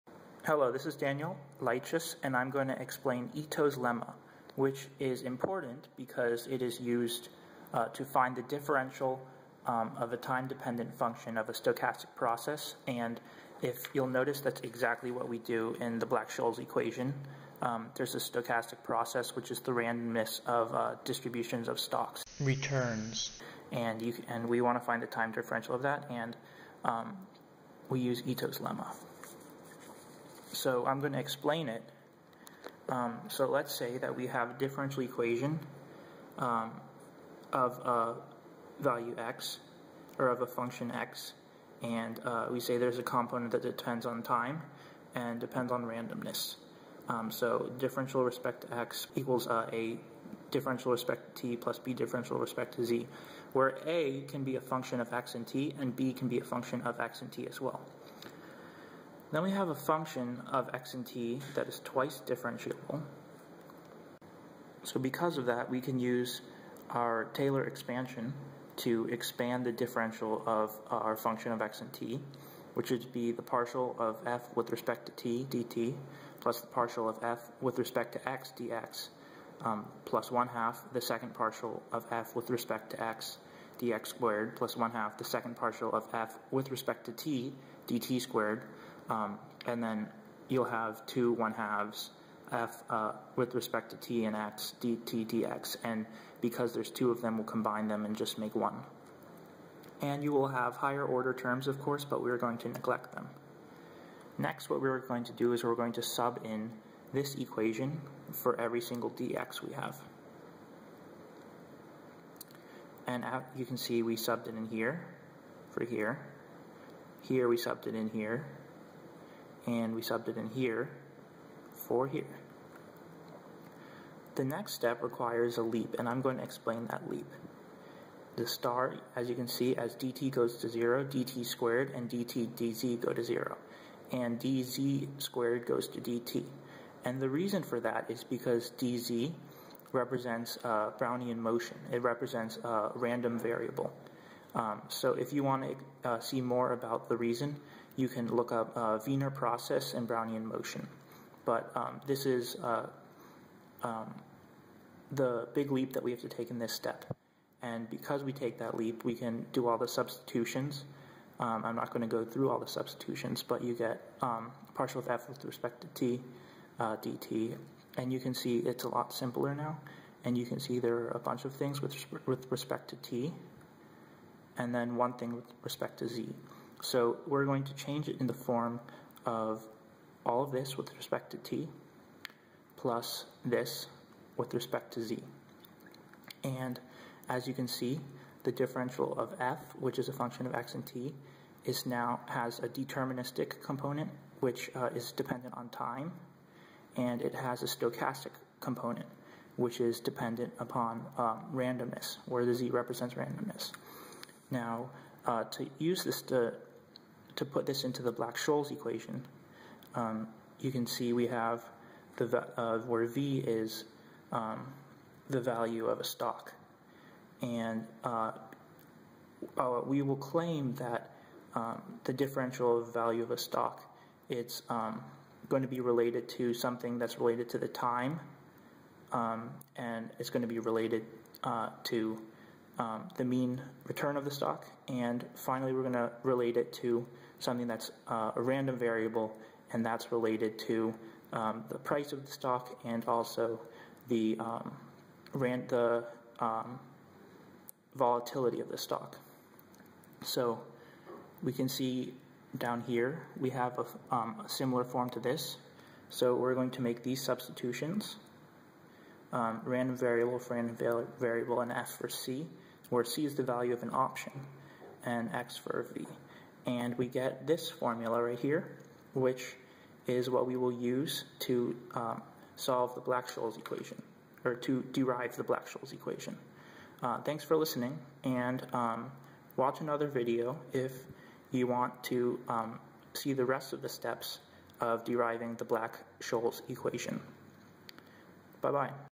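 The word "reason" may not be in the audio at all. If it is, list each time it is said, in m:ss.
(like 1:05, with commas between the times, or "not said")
2:17, 2:27.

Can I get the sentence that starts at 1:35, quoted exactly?
And because there's two of them, we'll combine them and just make one.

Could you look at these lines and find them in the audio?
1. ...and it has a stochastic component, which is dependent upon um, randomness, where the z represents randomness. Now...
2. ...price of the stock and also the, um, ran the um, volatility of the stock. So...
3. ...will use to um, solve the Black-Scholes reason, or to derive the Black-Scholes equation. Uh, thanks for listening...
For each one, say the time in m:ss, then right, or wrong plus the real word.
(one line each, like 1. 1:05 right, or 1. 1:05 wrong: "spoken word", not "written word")
1. 3:16 right
2. 4:01 right
3. 4:30 wrong: "equation", not "reason".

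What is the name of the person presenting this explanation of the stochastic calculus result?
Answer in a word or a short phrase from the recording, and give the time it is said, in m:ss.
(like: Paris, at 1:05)
Daniel Leichus, at 0:00.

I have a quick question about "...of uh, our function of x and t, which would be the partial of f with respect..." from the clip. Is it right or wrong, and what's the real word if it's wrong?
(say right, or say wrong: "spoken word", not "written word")
right.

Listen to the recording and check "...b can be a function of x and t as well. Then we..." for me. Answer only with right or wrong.
right.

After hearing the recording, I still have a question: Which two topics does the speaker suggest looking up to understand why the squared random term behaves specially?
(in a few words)
Wiener process and Brownian motion.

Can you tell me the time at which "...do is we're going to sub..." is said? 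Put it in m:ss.
1:45.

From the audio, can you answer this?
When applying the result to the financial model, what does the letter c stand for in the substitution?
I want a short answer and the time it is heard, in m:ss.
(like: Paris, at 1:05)
value of an option, at 4:23.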